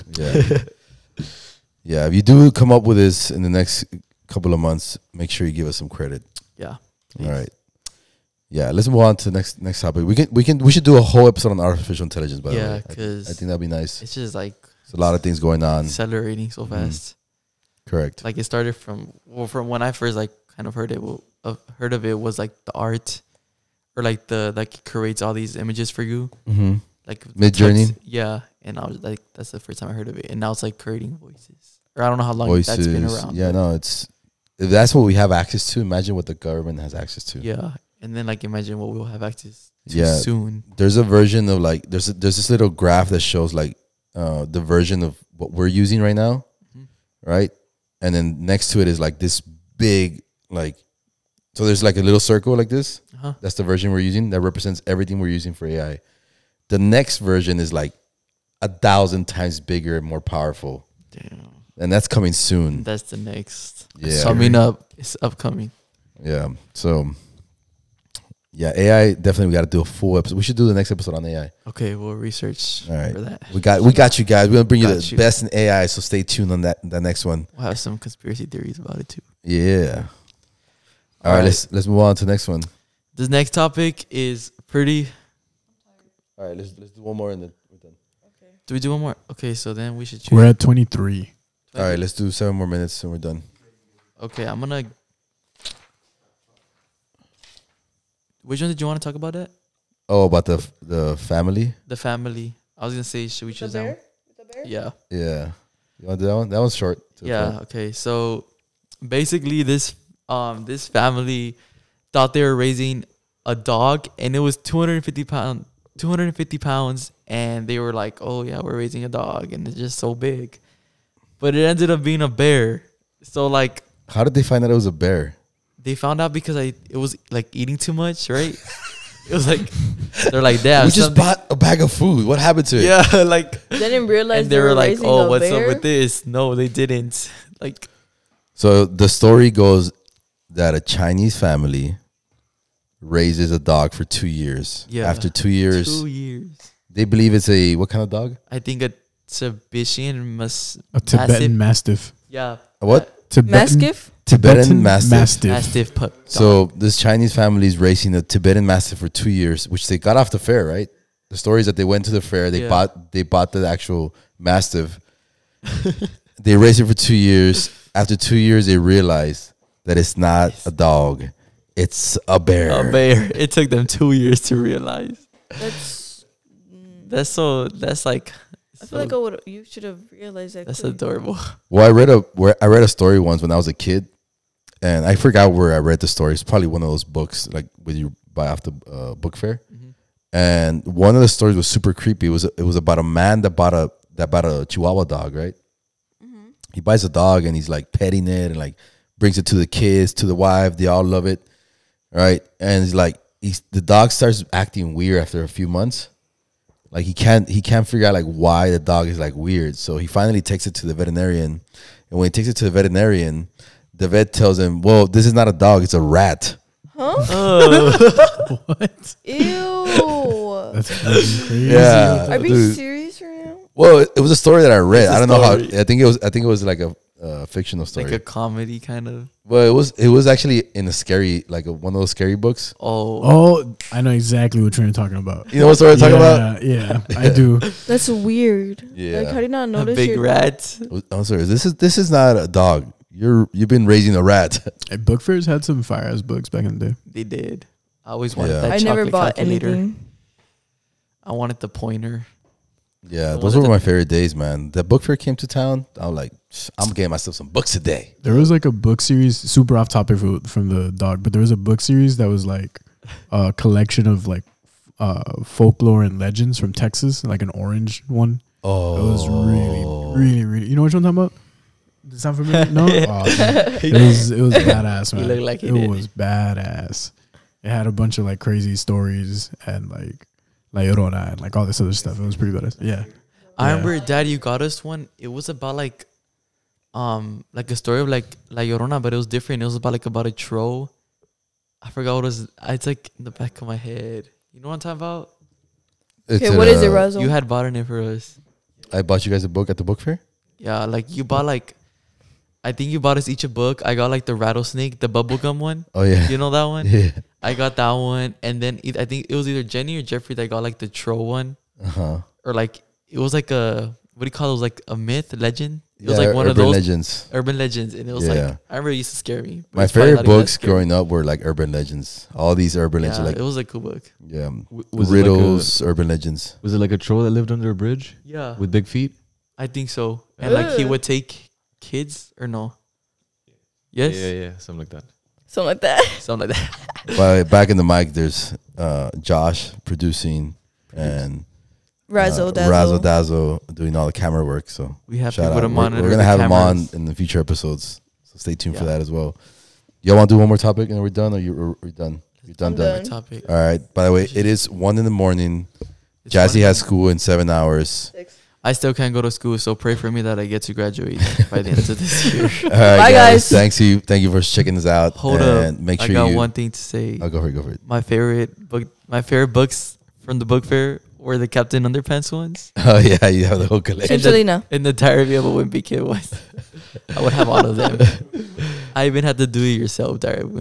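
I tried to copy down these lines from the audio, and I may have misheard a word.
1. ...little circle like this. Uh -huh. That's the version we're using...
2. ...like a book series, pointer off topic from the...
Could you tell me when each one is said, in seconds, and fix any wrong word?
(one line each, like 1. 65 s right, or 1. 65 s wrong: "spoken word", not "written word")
1. 52 s right
2. 258 s wrong: "super", not "pointer".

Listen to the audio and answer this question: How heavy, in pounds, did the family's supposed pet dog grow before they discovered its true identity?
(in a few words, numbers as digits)
250.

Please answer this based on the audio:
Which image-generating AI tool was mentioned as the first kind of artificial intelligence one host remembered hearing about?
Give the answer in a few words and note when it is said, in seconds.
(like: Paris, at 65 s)
Midjourney, at 27 s.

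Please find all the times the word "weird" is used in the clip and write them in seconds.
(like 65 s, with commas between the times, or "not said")
204 s, 209 s, 238 s.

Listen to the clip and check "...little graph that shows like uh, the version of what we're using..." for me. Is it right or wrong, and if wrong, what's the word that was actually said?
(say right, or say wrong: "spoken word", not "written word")
right.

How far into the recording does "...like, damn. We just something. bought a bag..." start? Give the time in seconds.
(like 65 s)
130 s.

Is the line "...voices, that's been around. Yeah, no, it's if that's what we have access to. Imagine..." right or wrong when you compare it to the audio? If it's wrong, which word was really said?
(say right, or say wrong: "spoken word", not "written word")
right.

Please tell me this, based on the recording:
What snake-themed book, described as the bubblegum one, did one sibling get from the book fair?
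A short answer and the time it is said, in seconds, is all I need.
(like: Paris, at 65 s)
The rattlesnake, at 304 s.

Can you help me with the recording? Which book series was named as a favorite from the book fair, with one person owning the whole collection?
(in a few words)
Captain Underpants.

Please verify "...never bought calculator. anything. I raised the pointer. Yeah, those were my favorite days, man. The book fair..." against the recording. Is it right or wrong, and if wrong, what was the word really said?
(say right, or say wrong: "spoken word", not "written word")
wrong: "wanted", not "raised".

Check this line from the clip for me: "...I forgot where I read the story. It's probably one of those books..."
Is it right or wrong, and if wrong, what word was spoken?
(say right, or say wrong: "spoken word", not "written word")
right.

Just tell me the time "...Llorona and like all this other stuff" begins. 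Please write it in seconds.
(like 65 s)
280 s.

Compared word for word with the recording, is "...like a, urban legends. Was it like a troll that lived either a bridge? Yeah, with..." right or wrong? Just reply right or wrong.
wrong.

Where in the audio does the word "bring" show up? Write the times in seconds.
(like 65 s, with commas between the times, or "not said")
74 s, 199 s.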